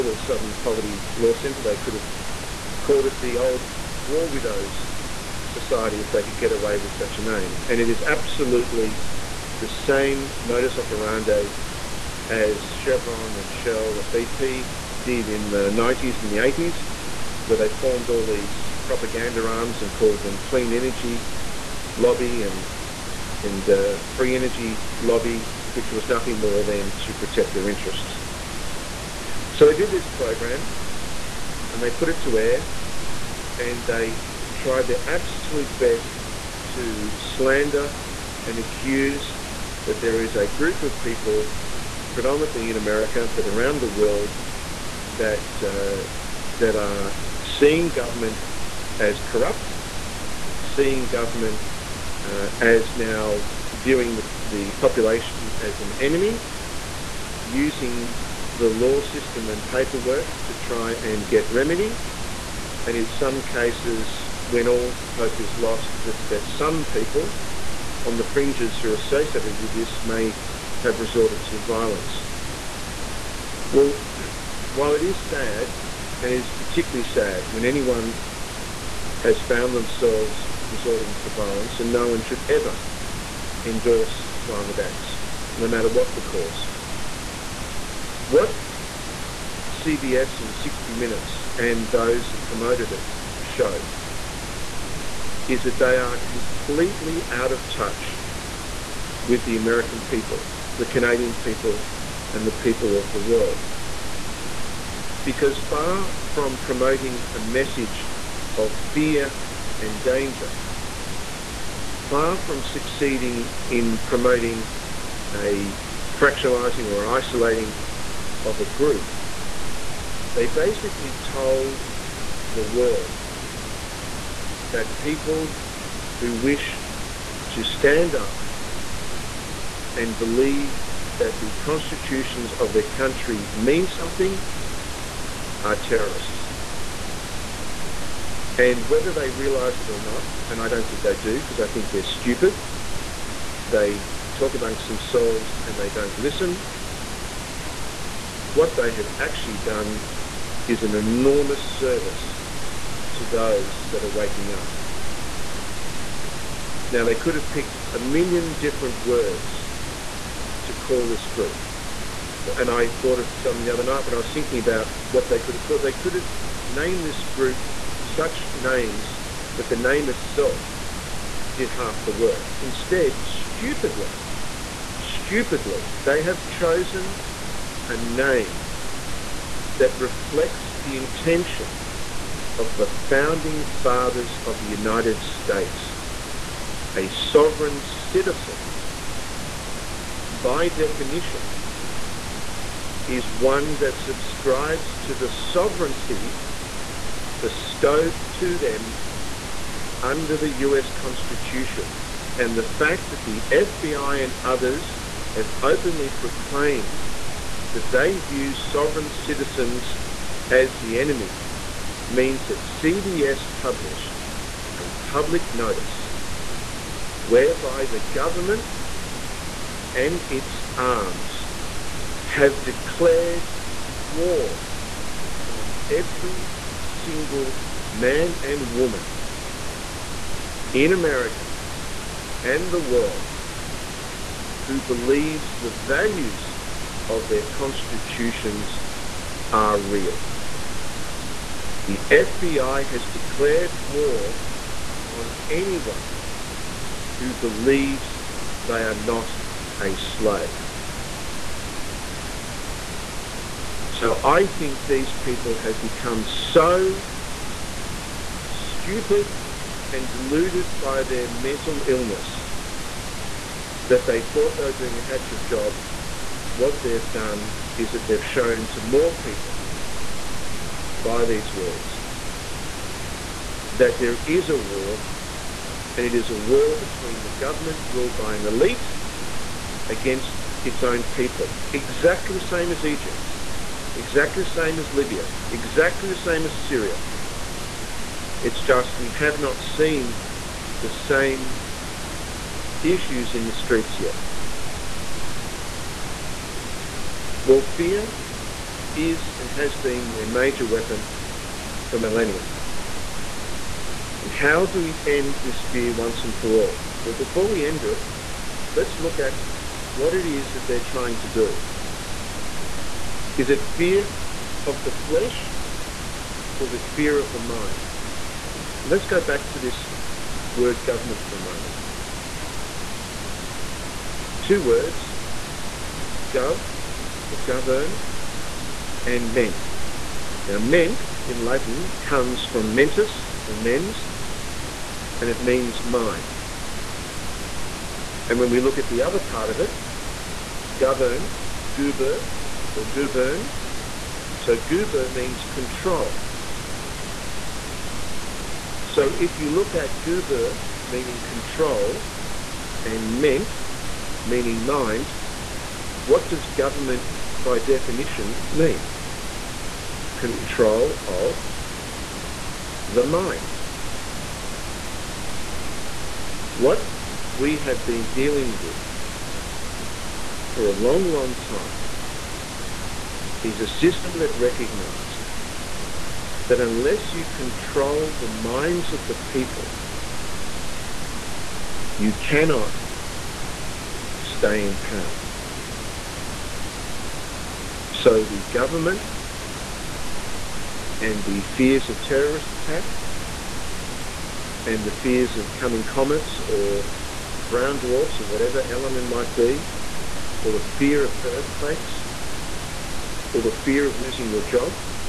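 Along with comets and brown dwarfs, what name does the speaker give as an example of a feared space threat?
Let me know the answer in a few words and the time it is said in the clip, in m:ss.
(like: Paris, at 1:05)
Elenin, at 6:38.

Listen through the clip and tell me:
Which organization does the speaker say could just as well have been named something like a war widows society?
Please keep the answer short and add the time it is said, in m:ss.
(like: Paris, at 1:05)
Southern Poverty Law Centre, at 0:00.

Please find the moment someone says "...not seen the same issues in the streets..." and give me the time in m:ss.
4:49.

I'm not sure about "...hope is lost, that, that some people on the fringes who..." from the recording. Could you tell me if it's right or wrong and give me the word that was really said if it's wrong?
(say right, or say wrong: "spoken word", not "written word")
right.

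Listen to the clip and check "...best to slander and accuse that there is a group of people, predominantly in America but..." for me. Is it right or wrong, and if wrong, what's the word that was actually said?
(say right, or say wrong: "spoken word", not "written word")
right.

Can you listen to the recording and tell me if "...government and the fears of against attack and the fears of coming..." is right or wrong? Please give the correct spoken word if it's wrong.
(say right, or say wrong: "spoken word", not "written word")
wrong: "terrorist", not "against".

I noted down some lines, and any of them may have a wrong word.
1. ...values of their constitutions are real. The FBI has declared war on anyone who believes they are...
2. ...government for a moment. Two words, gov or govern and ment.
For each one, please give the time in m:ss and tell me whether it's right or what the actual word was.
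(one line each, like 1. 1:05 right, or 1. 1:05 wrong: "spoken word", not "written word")
1. 3:55 right
2. 5:20 right.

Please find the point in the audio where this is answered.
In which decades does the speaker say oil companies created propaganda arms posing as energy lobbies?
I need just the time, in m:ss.
0:15.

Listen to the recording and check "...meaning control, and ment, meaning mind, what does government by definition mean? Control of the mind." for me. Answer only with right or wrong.
right.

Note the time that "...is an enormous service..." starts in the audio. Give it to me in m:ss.
2:30.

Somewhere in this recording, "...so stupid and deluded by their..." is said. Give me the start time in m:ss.
4:16.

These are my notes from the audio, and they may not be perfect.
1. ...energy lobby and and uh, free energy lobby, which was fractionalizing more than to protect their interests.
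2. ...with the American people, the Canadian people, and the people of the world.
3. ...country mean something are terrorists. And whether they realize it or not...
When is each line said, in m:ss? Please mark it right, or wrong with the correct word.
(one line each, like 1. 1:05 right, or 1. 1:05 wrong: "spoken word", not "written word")
1. 0:20 wrong: "nothing", not "fractionalizing"
2. 1:39 right
3. 2:12 right.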